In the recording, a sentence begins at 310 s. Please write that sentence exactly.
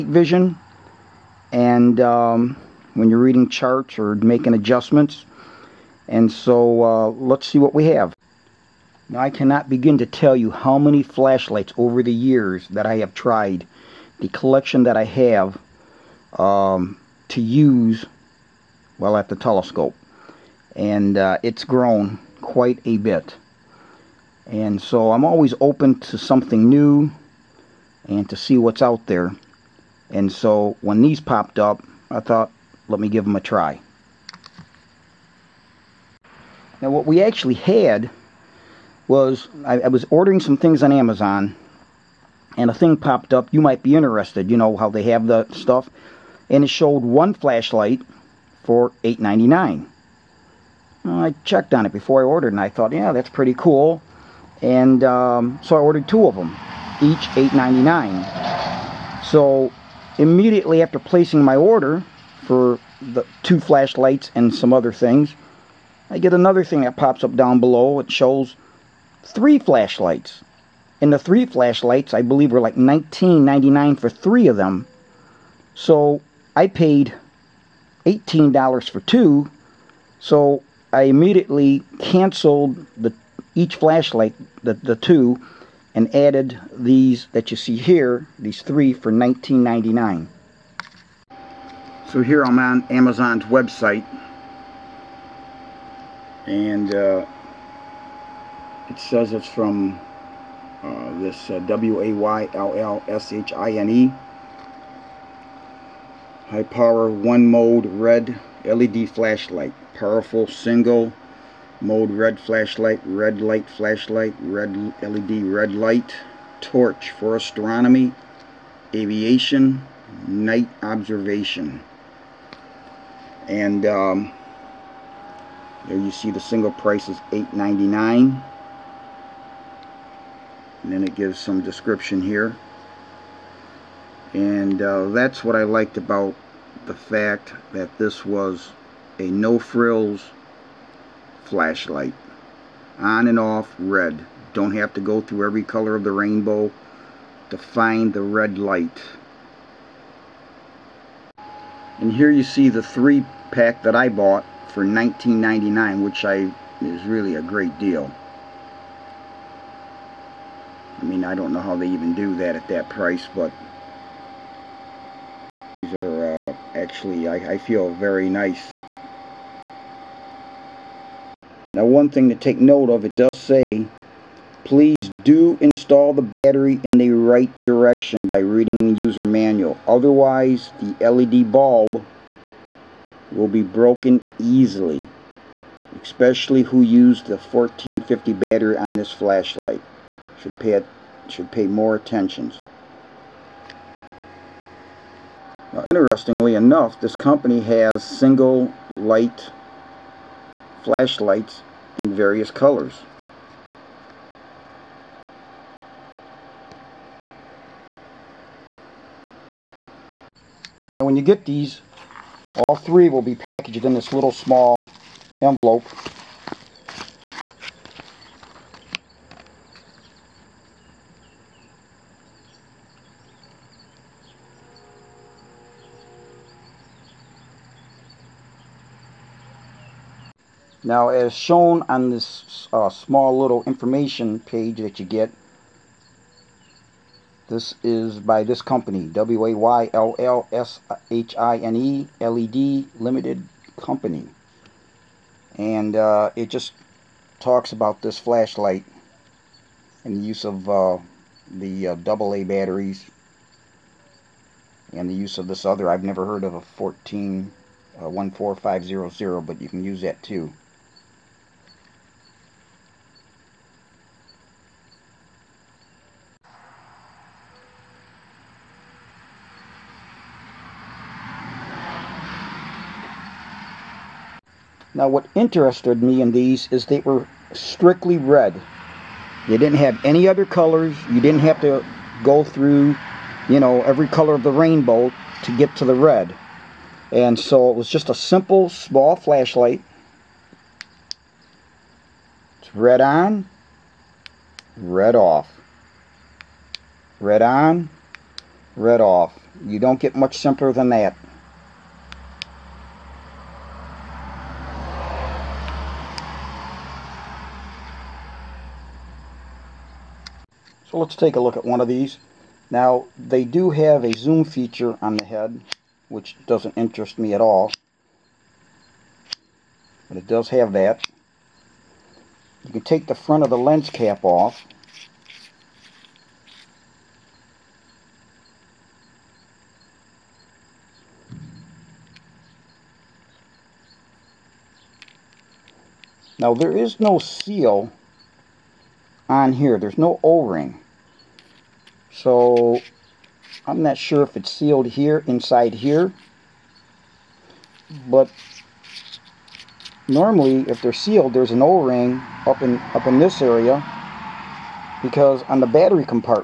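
let's take a look at one of these.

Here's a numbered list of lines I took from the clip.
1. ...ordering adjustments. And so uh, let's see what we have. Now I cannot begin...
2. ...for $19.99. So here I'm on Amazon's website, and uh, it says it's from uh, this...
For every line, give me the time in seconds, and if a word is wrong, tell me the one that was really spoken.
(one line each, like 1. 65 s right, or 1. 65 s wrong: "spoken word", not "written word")
1. 4 s wrong: "making", not "ordering"
2. 88 s right.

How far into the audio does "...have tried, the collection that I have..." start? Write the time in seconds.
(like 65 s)
12 s.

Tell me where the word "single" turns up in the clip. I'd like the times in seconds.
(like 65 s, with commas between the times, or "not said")
110 s, 126 s, 198 s.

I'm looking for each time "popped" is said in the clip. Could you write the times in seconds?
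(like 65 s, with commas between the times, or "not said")
31 s, 42 s.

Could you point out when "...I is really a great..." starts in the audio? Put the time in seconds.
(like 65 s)
156 s.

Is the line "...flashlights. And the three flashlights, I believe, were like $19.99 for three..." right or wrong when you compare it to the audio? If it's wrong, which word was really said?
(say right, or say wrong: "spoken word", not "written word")
right.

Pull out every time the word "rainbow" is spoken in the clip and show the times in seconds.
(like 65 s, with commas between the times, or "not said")
146 s, 284 s.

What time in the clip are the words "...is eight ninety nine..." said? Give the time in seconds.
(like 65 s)
127 s.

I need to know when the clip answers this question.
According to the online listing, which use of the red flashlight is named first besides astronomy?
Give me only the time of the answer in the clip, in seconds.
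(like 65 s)
118 s.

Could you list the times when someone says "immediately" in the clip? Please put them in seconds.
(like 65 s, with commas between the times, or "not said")
60 s, 81 s.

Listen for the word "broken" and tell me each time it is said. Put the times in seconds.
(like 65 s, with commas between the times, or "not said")
183 s.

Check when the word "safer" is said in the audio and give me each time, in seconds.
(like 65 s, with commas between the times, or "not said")
not said.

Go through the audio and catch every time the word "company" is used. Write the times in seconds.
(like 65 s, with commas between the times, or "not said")
197 s, 238 s, 243 s.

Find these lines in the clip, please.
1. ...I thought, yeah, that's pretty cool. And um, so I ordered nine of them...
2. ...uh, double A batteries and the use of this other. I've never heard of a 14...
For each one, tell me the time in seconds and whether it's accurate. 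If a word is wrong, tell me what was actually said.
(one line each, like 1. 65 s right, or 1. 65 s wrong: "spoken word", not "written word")
1. 52 s wrong: "two", not "nine"
2. 251 s right.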